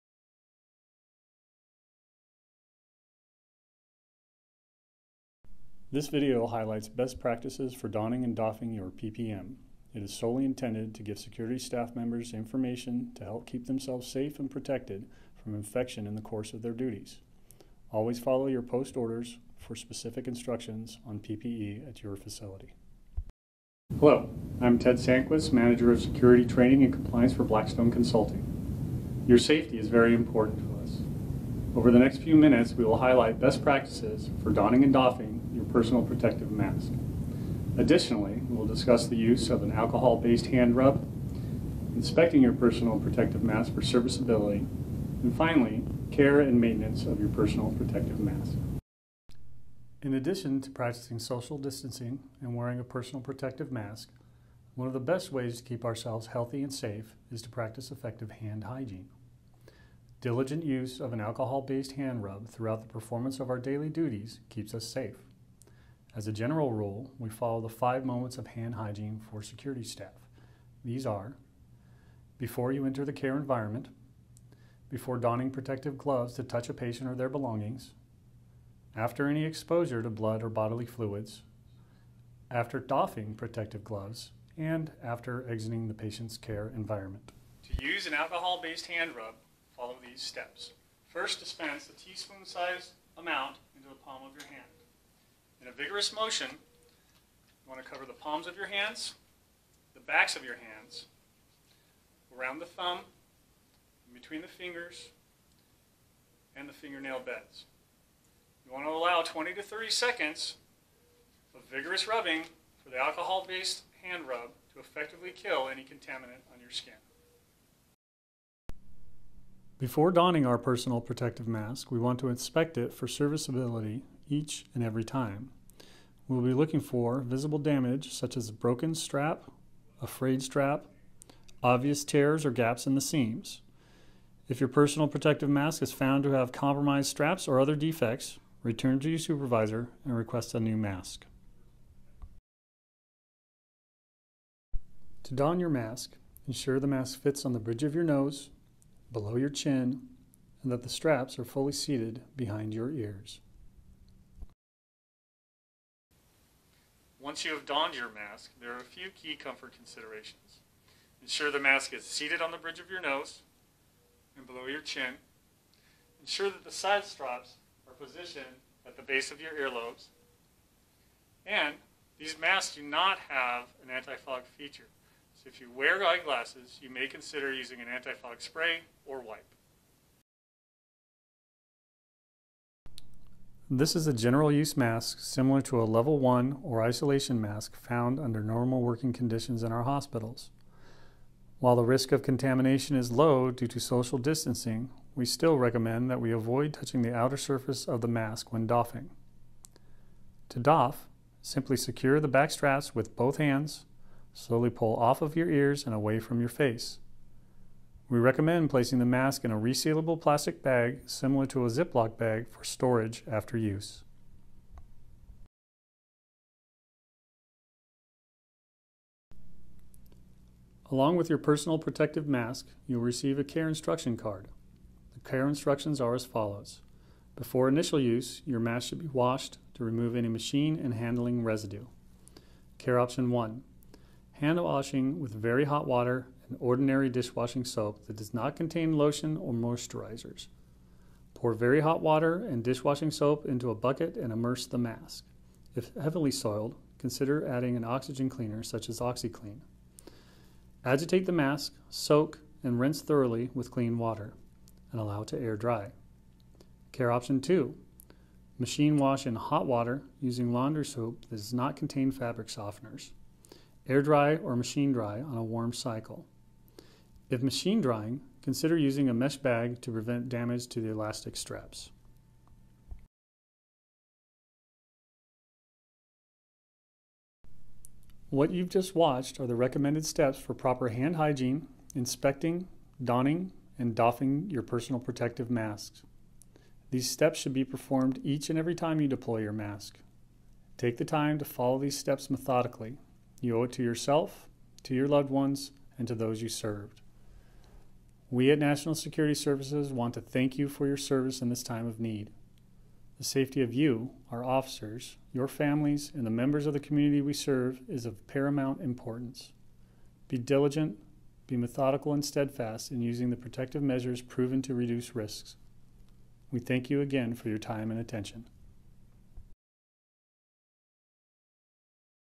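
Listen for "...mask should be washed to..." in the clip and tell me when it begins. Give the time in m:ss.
3:48.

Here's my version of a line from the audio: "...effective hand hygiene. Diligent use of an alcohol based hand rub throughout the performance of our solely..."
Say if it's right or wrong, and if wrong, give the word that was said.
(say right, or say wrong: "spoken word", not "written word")
wrong: "daily", not "solely".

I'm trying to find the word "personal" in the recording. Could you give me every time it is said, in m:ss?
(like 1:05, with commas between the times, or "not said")
0:35, 0:42, 0:47, 0:52, 2:00, 2:14, 3:41, 4:44.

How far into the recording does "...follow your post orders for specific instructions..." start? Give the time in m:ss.
0:18.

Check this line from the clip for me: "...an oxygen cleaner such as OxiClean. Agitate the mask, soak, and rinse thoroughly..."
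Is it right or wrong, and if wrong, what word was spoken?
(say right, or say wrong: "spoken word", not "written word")
right.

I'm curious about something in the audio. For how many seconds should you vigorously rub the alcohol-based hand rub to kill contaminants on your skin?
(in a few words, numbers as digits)
20 to 30 seconds.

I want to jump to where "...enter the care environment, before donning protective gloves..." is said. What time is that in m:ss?
1:12.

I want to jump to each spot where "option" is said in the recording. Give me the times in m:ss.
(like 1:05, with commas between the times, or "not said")
3:52, 4:17.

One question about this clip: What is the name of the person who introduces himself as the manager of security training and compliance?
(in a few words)
Ted Sanquist.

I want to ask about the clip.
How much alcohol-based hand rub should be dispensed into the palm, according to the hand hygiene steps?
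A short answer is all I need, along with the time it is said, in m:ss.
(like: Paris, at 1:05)
A teaspoon-sized amount, at 1:31.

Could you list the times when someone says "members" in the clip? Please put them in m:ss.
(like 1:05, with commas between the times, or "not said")
0:11, 5:06.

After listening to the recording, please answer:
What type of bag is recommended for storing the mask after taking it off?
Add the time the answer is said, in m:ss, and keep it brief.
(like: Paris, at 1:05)
Resealable plastic bag, at 3:29.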